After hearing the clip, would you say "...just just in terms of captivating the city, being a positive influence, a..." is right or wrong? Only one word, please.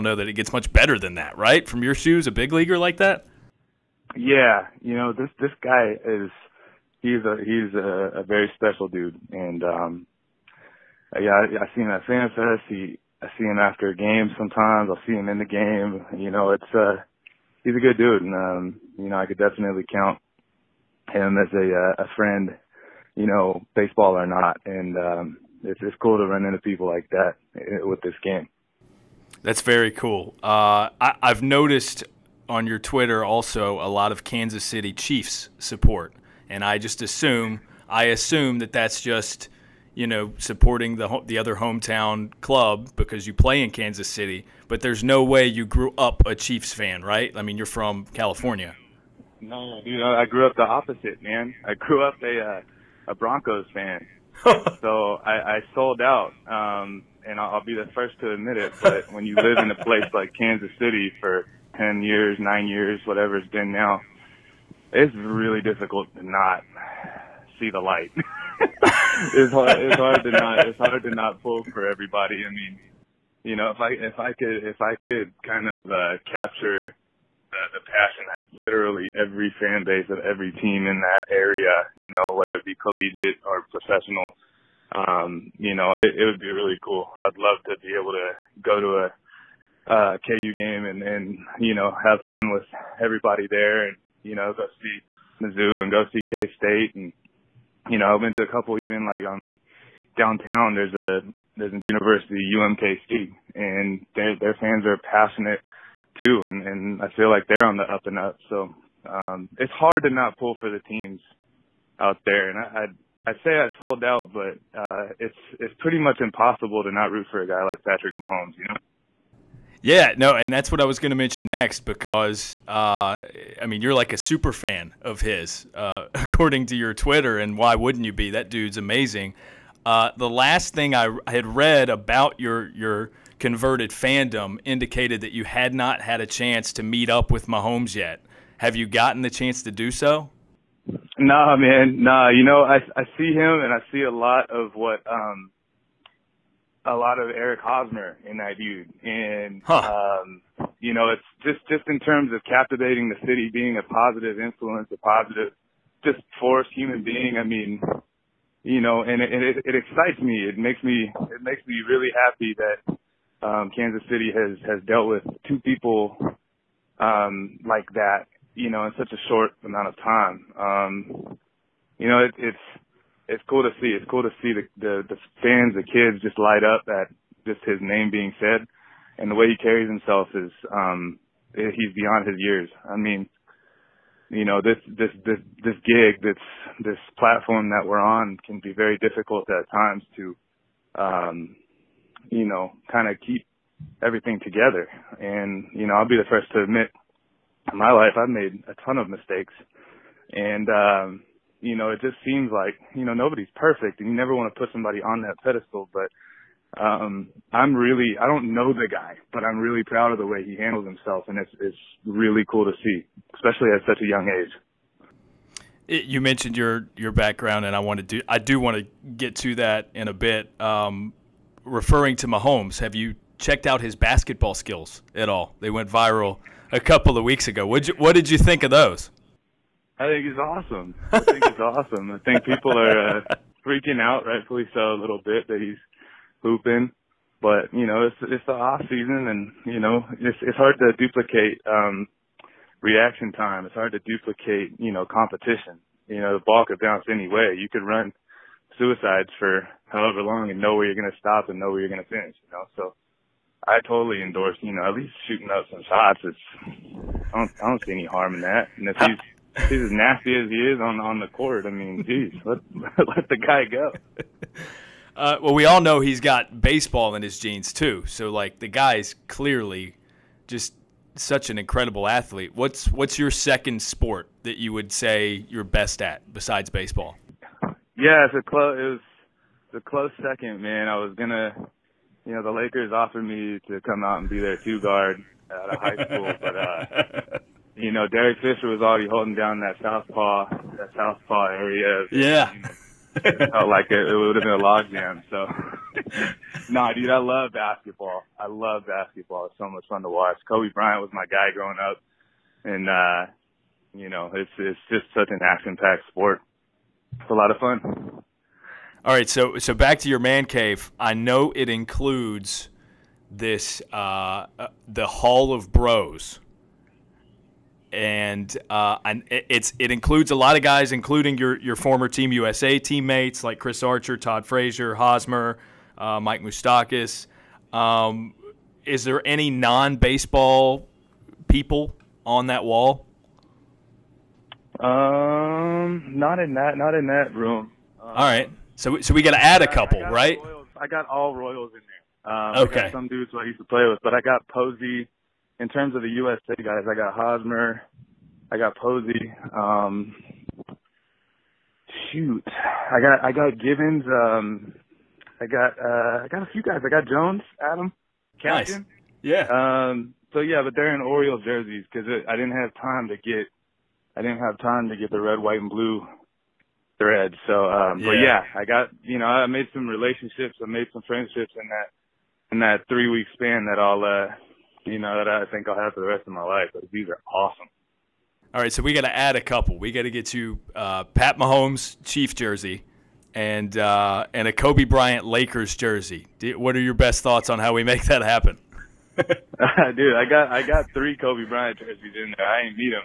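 right.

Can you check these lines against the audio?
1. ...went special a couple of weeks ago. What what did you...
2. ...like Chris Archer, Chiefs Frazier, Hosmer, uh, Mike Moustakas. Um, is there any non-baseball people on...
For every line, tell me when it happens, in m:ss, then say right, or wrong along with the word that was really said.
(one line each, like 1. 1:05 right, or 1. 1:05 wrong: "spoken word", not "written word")
1. 3:45 wrong: "viral", not "special"
2. 5:23 wrong: "Todd", not "Chiefs".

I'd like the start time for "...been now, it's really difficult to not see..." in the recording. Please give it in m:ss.
1:03.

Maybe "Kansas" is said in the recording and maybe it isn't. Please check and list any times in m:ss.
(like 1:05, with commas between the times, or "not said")
0:34, 0:43, 1:00, 2:43.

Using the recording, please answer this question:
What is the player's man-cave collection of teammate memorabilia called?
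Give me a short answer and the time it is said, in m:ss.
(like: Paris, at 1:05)
Hall of Bros, at 5:15.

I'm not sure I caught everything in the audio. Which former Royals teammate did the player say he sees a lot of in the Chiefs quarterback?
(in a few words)
Eric Hosmer.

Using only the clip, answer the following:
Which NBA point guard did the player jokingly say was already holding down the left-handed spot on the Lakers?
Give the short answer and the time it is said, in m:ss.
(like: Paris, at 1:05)
Derek Fisher, at 4:48.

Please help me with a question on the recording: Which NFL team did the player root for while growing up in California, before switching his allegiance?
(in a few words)
Broncos.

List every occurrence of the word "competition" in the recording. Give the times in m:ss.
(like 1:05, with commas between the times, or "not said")
4:05.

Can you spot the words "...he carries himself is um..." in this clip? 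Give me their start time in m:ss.
2:59.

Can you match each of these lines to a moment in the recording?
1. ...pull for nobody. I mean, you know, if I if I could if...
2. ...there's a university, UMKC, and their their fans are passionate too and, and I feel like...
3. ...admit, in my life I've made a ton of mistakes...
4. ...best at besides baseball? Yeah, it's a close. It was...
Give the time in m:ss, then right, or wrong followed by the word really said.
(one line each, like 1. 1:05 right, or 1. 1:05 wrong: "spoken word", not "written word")
1. 1:11 wrong: "everybody", not "nobody"
2. 1:41 right
3. 3:16 right
4. 4:35 right.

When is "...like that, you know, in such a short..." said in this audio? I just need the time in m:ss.
2:47.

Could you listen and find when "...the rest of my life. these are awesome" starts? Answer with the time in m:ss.
6:16.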